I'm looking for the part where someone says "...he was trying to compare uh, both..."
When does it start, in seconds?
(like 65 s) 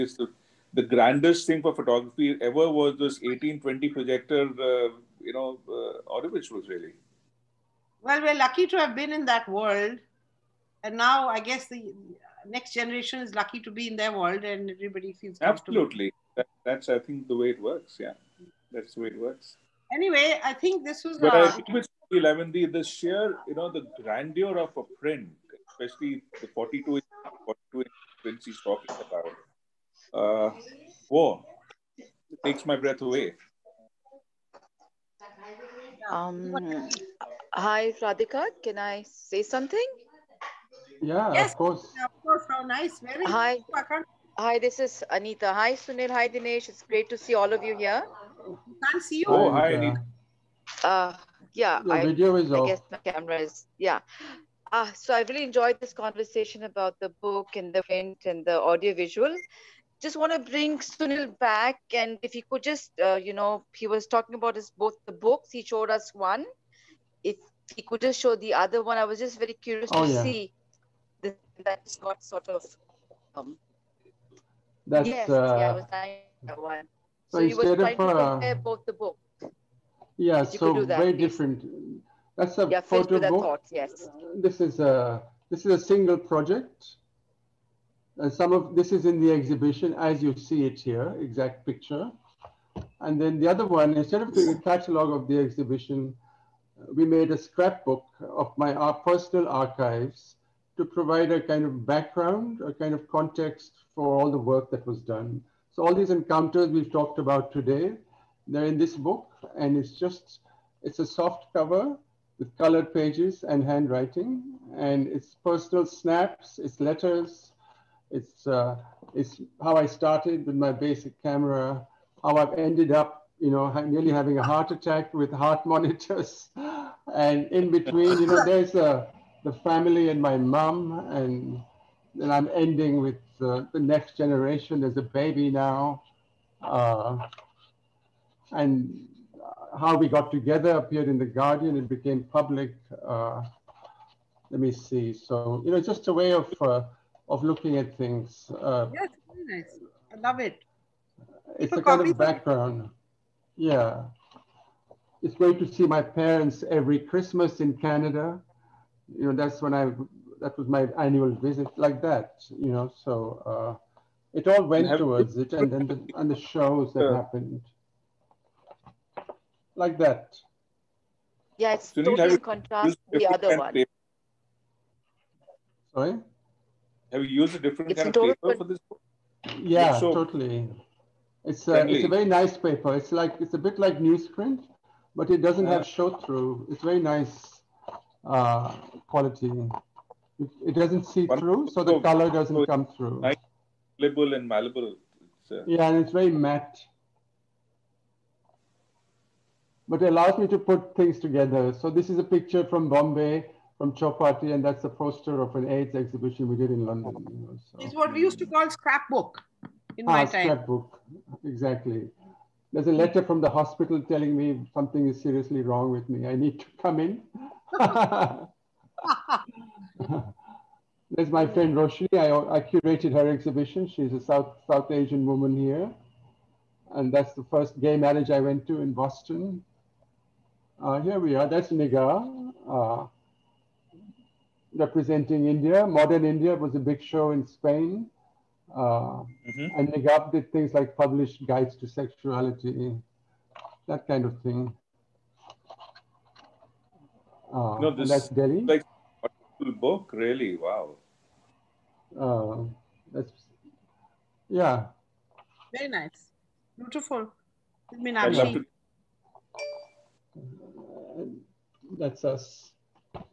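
77 s.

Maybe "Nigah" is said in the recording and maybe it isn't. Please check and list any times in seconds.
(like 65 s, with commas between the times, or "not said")
231 s, 239 s.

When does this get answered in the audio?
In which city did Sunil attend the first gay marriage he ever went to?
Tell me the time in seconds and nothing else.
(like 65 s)
228 s.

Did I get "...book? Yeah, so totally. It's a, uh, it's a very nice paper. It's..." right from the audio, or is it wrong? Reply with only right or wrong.
right.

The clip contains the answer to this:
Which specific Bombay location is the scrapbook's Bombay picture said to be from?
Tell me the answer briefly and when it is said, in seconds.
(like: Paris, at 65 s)
Chowpatty, at 203 s.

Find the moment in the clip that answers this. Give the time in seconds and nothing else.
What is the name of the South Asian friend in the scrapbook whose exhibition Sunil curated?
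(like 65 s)
221 s.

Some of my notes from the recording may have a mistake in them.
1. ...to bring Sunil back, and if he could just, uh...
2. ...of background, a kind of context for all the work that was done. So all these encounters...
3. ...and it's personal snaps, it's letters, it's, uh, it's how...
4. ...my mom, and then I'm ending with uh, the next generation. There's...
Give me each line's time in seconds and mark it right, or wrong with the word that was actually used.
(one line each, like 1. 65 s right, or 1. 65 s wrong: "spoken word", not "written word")
1. 60 s right
2. 101 s right
3. 114 s right
4. 130 s right.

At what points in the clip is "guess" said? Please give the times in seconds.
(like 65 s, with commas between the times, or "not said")
11 s, 52 s.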